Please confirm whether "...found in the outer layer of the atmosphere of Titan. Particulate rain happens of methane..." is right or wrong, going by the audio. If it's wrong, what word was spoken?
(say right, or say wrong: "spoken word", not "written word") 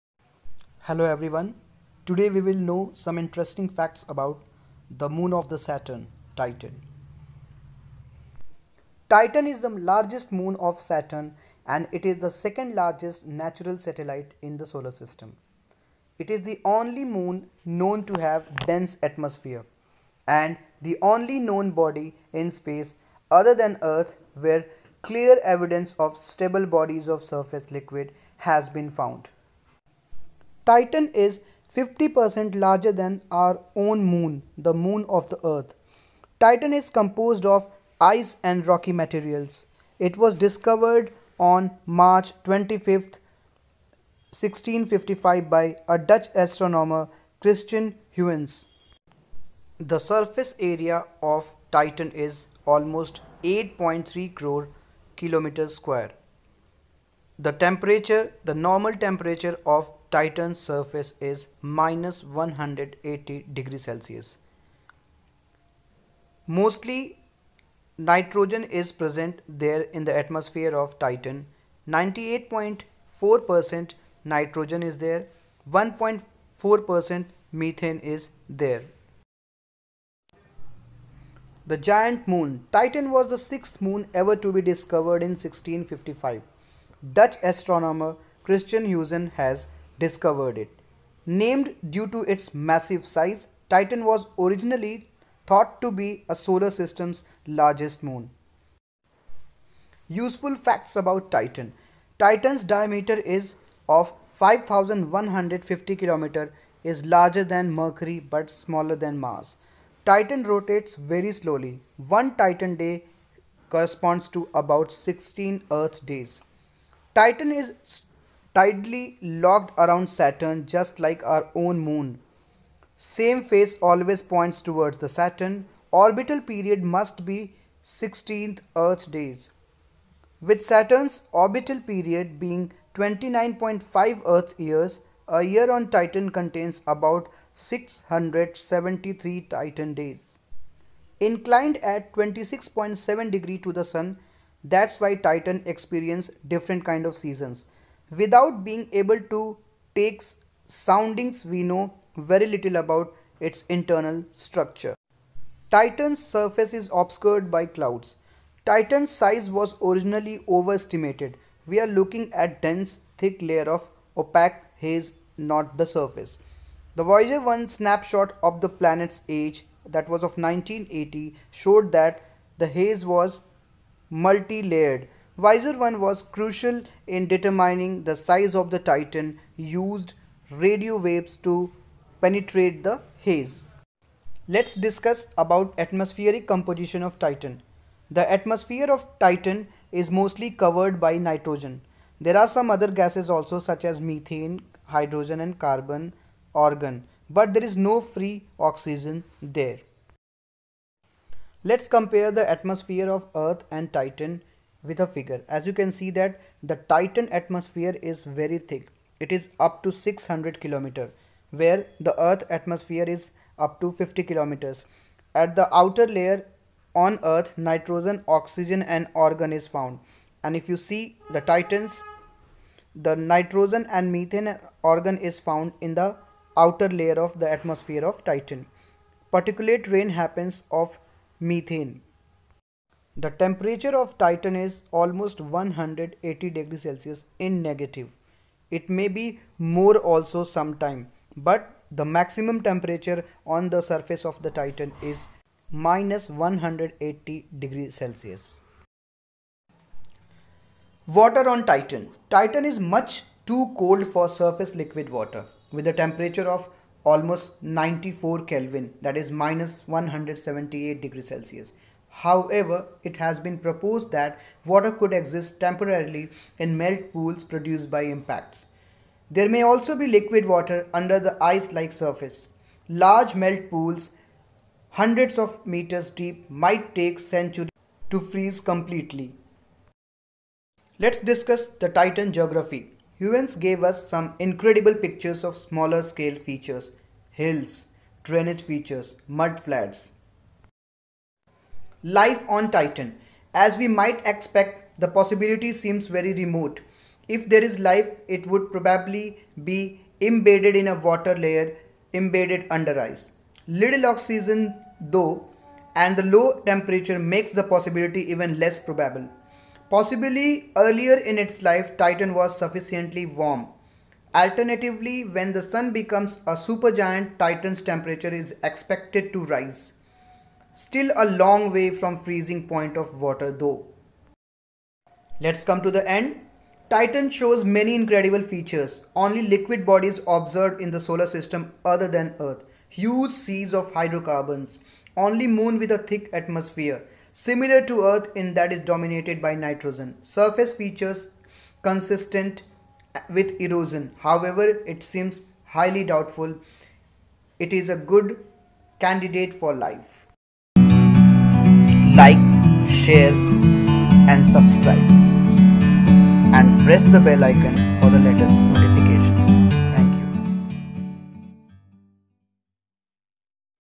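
right.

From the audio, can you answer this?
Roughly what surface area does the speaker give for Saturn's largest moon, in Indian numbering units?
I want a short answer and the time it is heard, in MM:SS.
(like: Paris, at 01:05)
8.3 crore square km, at 00:53.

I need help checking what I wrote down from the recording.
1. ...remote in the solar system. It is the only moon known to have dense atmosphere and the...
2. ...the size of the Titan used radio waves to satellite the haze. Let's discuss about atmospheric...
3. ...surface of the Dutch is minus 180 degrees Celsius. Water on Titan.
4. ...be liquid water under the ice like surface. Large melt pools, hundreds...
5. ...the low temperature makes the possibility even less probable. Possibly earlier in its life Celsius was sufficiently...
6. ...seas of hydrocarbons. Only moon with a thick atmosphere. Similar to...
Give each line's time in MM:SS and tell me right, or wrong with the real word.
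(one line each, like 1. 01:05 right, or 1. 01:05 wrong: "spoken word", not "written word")
1. 00:13 wrong: "satellite", not "remote"
2. 02:58 wrong: "penetrate", not "satellite"
3. 04:03 wrong: "Titan", not "Dutch"
4. 04:29 right
5. 05:06 wrong: "Titan", not "Celsius"
6. 05:33 right.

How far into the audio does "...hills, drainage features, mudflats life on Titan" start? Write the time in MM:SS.
04:47.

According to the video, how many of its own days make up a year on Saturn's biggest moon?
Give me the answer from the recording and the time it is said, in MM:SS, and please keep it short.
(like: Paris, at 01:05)
673, at 02:17.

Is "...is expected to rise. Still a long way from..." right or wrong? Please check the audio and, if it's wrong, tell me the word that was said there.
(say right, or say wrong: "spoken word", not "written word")
right.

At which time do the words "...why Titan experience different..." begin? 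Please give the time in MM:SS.
02:24.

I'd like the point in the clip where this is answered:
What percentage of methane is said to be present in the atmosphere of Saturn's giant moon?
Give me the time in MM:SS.
01:15.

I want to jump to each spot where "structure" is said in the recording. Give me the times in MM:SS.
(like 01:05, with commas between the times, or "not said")
02:34.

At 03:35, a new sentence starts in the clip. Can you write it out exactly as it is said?
At the outer layer on earth nitrogen, oxygen and argon is found.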